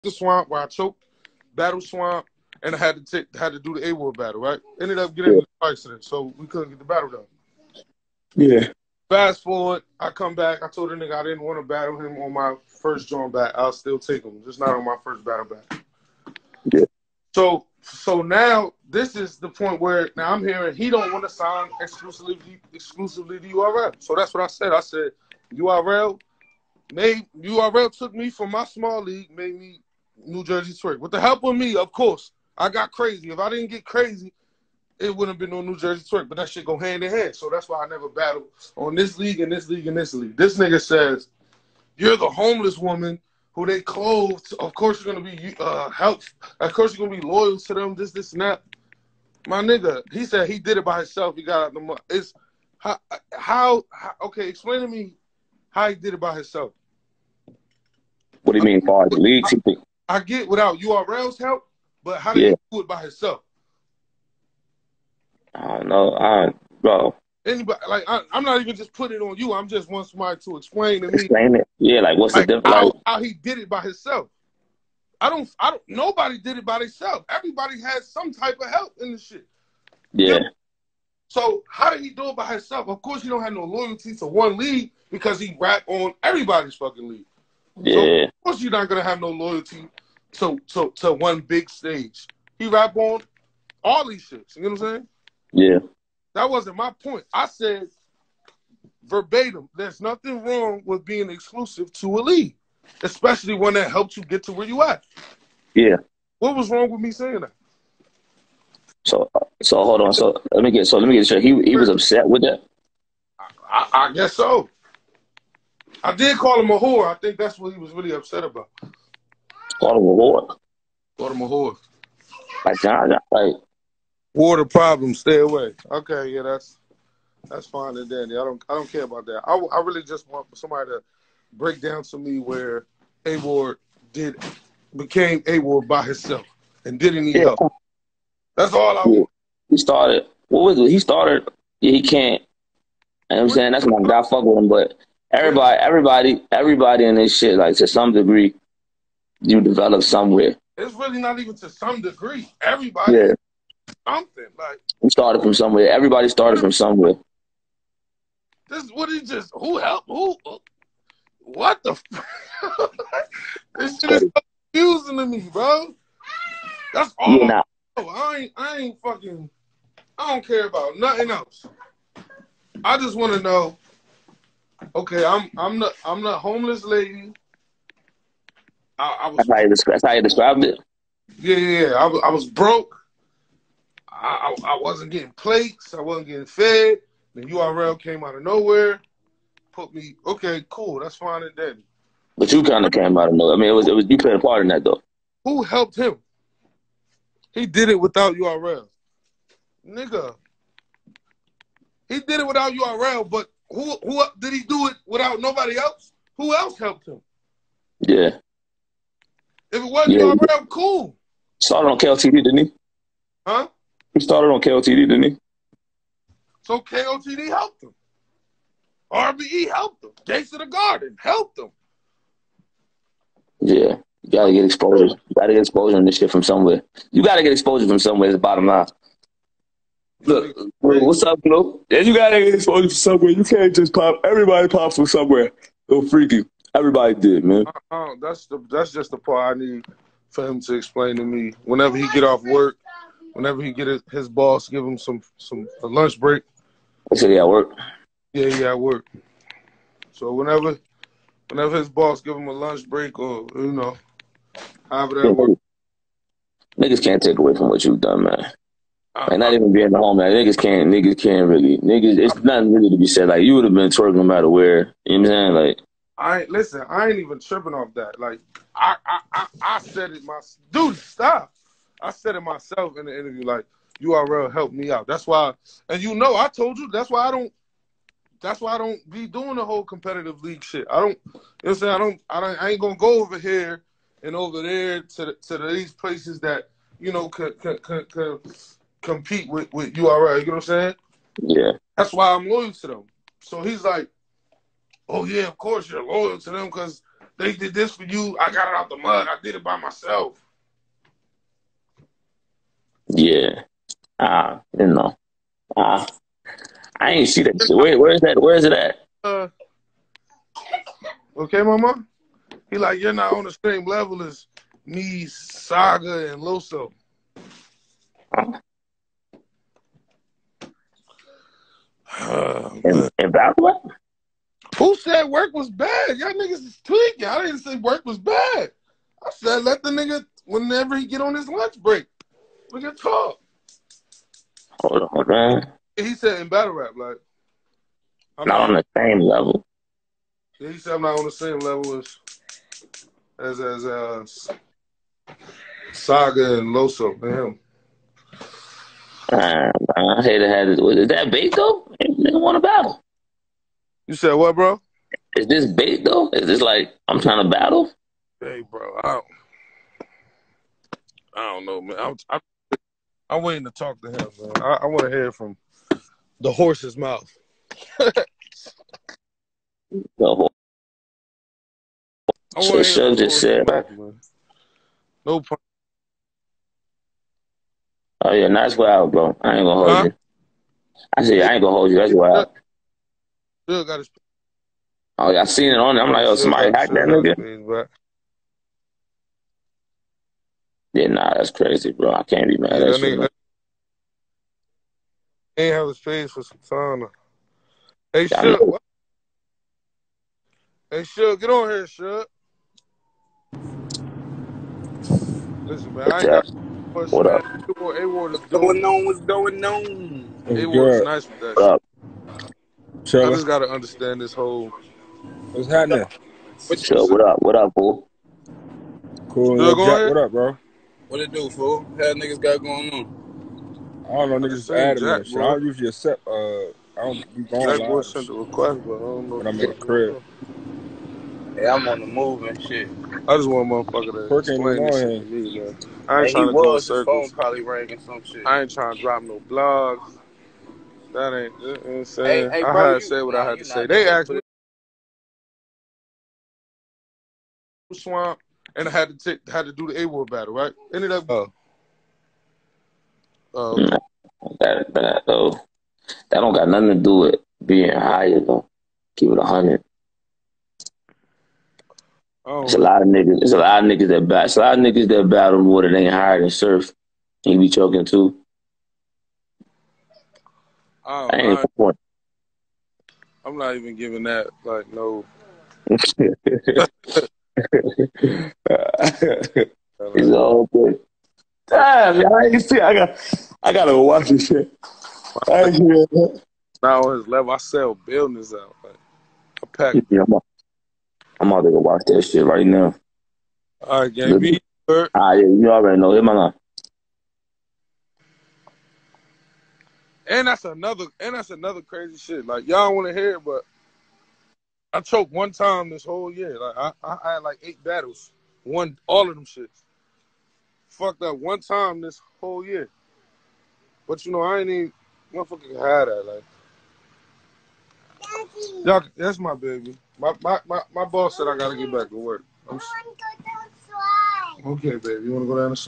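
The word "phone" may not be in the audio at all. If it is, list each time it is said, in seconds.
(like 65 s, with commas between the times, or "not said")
437 s.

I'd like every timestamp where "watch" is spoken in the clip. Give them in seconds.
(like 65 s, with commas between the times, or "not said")
483 s, 491 s.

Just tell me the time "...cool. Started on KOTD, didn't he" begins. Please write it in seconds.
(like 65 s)
210 s.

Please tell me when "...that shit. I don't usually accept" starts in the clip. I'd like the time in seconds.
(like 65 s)
425 s.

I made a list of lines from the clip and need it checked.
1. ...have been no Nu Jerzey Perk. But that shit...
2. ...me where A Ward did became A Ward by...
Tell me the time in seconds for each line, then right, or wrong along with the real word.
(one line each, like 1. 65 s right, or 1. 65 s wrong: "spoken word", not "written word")
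1. 35 s wrong: "Twork", not "Perk"
2. 132 s right.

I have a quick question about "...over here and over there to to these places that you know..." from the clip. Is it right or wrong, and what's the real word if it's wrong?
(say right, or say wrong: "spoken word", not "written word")
right.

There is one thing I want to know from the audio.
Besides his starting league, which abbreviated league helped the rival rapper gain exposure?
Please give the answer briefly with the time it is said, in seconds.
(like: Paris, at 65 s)
RBE, at 219 s.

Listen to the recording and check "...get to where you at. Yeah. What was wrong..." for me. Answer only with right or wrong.
right.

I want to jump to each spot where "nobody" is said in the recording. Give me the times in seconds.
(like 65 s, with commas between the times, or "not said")
75 s, 205 s.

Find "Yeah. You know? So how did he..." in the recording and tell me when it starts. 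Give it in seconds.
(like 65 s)
80 s.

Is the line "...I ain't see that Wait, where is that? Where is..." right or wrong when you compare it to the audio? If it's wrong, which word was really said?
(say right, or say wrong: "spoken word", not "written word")
right.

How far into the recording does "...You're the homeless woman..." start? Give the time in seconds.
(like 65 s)
41 s.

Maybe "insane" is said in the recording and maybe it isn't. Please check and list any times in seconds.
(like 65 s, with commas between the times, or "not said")
441 s.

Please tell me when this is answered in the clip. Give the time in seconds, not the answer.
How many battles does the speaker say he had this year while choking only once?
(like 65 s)
507 s.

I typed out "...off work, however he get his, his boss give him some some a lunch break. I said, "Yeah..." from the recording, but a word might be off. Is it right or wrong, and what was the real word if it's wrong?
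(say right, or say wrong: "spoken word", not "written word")
wrong: "whenever", not "however".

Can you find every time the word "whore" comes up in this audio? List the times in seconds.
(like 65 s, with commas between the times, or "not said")
116 s, 121 s.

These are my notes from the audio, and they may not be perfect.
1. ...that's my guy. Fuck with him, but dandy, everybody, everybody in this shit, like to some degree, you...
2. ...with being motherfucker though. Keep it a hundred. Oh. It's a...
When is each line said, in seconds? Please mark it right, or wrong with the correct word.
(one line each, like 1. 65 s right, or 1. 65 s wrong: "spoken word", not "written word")
1. 143 s wrong: "everybody", not "dandy"
2. 457 s wrong: "higher", not "motherfucker".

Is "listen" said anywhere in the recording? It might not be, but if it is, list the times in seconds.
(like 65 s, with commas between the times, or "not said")
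266 s, 405 s.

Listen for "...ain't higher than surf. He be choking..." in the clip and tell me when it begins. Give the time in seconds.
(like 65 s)
465 s.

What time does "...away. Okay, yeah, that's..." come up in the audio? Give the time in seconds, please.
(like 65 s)
125 s.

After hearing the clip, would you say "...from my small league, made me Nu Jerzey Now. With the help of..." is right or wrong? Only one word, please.
wrong.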